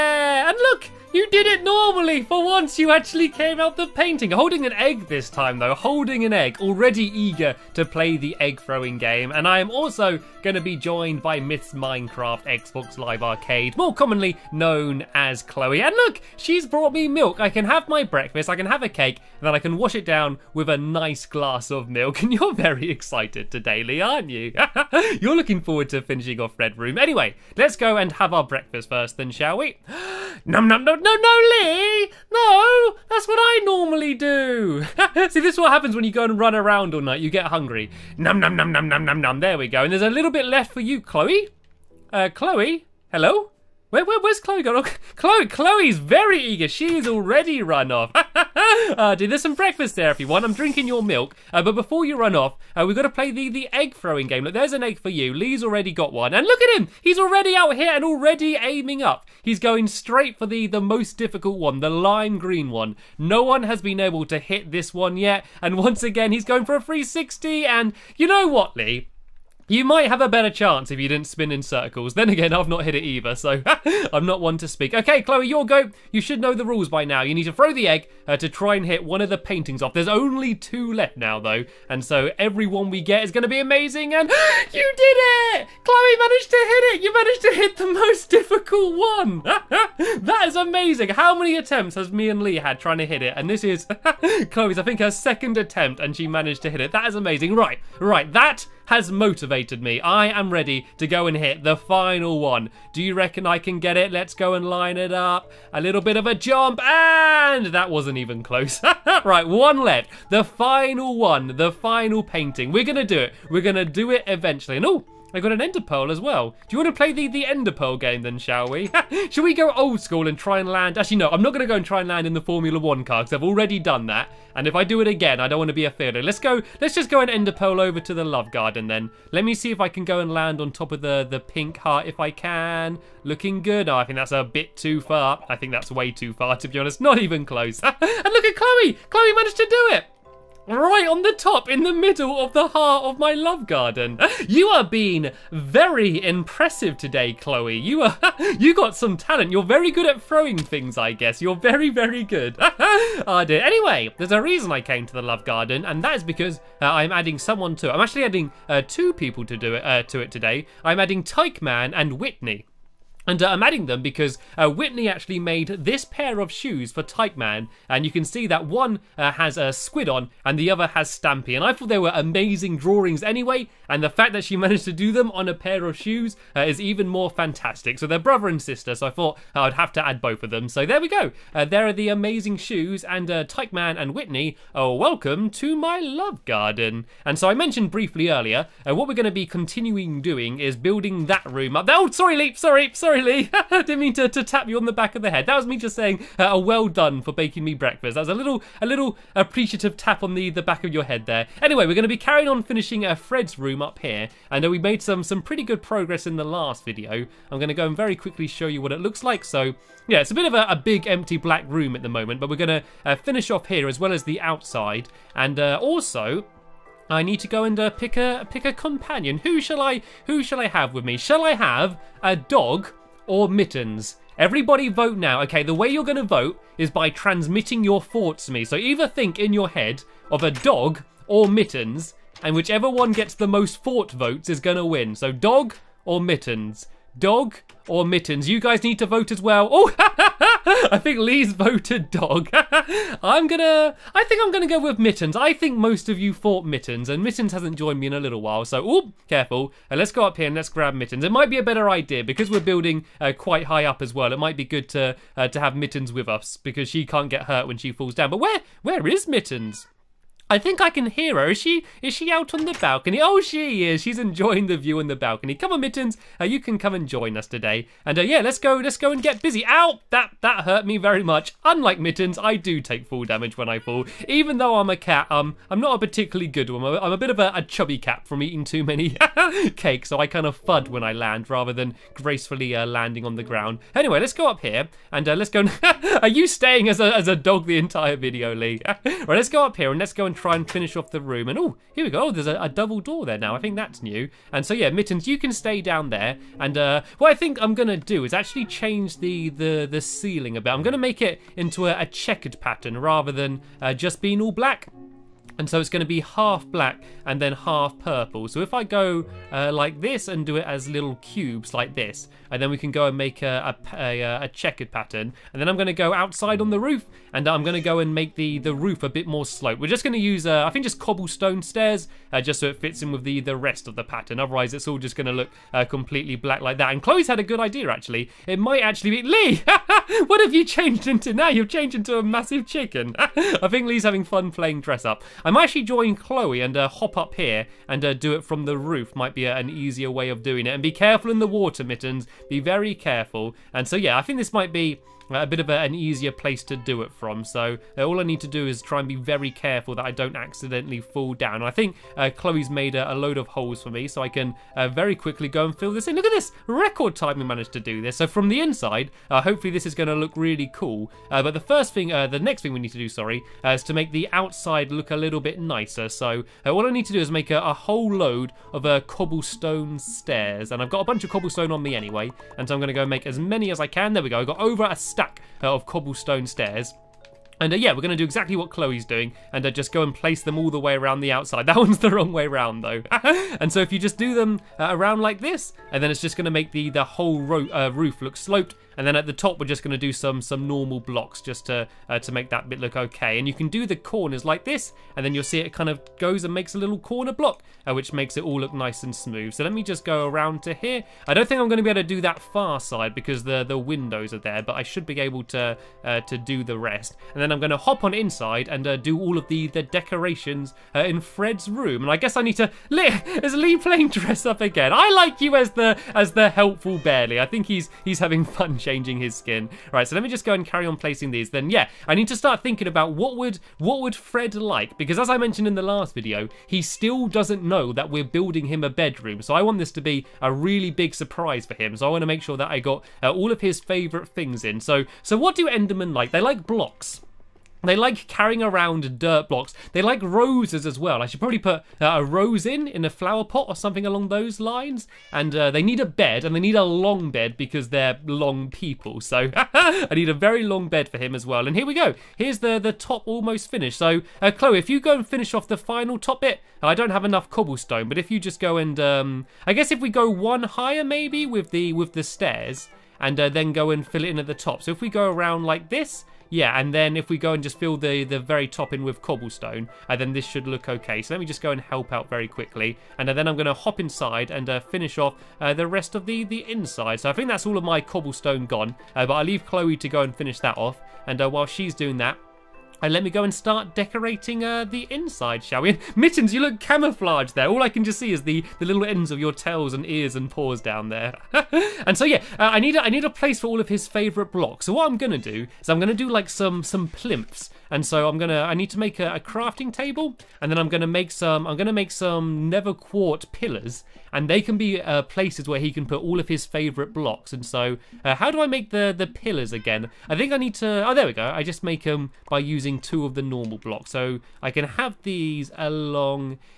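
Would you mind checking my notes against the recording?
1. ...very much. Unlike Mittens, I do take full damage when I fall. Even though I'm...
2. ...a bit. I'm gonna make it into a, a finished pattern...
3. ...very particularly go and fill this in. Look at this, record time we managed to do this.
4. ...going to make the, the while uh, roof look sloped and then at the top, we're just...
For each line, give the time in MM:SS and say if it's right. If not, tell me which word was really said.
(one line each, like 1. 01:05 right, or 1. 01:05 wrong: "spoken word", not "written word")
1. 04:30 right
2. 05:00 wrong: "checkered", not "finished"
3. 05:54 wrong: "quickly", not "particularly"
4. 06:26 wrong: "whole", not "while".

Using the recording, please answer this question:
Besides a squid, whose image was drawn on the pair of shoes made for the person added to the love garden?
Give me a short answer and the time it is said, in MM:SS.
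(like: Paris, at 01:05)
Stampy, at 02:51.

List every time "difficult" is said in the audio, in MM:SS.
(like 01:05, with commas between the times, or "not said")
01:01, 01:28.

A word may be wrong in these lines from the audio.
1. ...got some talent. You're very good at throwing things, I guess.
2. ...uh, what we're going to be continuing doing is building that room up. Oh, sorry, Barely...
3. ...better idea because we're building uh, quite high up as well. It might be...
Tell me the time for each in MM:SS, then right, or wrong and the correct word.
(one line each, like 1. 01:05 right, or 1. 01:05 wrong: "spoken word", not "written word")
1. 02:28 right
2. 03:08 wrong: "Leap", not "Barely"
3. 04:11 right.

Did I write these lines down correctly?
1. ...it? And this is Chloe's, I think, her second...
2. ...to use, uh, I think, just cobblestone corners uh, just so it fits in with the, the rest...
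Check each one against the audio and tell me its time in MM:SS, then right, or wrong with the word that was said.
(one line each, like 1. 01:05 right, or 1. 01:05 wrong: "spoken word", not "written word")
1. 01:33 right
2. 05:20 wrong: "stairs", not "corners".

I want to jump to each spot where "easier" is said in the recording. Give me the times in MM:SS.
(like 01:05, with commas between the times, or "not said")
05:39, 05:45.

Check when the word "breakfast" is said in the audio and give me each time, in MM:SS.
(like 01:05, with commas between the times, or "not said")
00:18, 00:28, 00:49, 03:17.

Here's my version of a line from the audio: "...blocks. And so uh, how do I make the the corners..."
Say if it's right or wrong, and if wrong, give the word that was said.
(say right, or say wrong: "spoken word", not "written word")
wrong: "pillars", not "corners".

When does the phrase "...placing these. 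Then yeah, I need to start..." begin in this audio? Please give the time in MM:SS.
07:00.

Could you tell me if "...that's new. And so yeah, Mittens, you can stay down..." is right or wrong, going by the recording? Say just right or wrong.
right.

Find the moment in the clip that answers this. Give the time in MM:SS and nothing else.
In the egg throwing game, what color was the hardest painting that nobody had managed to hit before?
01:01.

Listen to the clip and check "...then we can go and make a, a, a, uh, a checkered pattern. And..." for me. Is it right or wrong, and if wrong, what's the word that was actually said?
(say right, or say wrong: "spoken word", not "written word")
right.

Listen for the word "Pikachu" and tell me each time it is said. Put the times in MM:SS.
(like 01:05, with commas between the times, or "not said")
not said.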